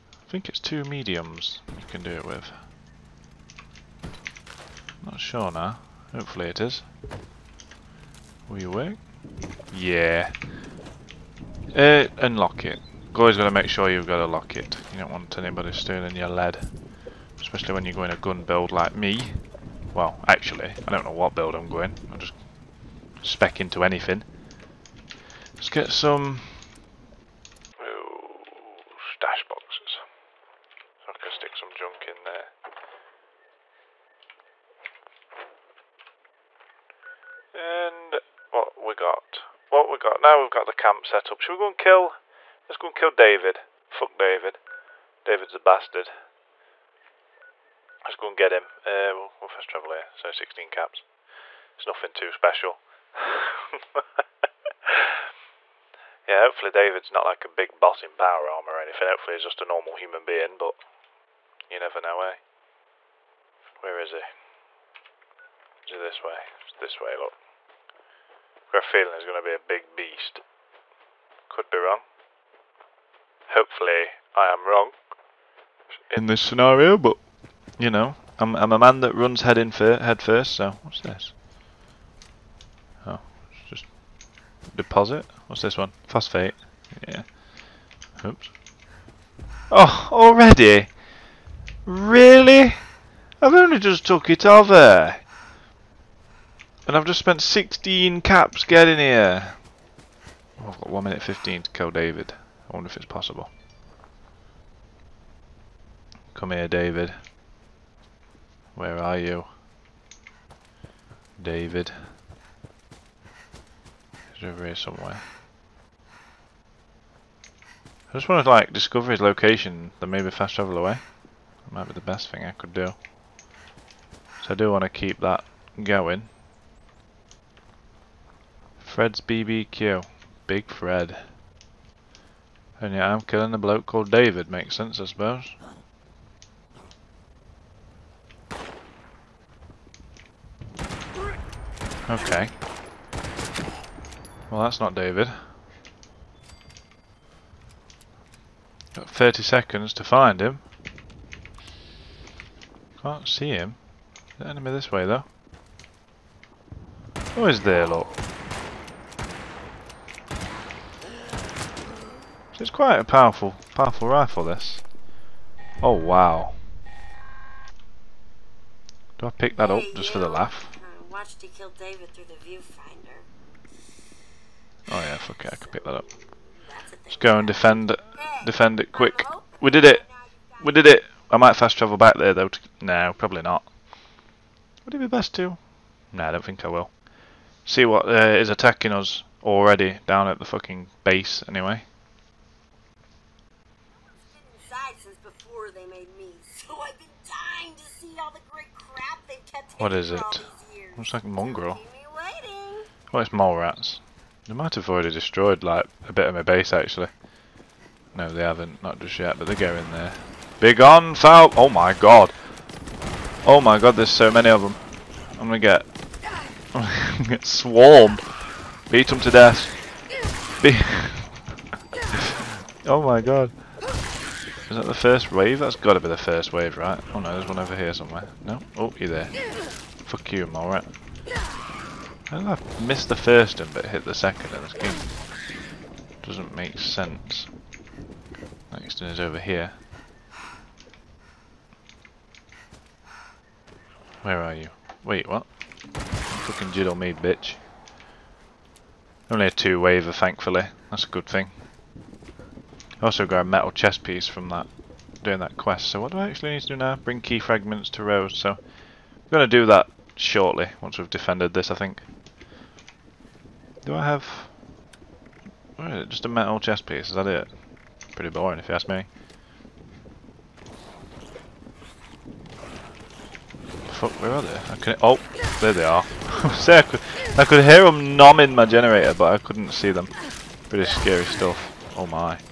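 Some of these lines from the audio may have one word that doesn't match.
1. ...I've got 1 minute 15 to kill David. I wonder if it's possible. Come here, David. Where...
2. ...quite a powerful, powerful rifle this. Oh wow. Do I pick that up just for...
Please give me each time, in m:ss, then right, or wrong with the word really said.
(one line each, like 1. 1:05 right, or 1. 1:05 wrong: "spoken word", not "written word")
1. 1:40 right
2. 2:42 right.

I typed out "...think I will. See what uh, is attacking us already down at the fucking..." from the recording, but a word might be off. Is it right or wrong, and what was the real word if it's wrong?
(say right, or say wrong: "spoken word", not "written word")
right.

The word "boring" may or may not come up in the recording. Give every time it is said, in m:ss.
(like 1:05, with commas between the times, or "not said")
4:28.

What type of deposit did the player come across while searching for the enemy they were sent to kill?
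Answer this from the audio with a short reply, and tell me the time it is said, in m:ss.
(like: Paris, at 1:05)
Phosphate, at 1:26.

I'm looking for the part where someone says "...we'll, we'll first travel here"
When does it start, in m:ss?
0:49.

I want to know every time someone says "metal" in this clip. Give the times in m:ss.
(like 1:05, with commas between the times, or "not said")
4:13, 4:26.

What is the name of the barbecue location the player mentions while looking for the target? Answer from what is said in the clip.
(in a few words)
Fred's BBQ.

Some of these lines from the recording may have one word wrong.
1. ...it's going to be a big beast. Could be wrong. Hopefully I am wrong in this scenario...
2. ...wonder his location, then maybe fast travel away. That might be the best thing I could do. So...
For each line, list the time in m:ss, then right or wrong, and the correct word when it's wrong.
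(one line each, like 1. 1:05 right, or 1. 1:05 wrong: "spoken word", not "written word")
1. 1:09 right
2. 1:58 wrong: "discover", not "wonder".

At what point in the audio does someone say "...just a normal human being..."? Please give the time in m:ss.
0:59.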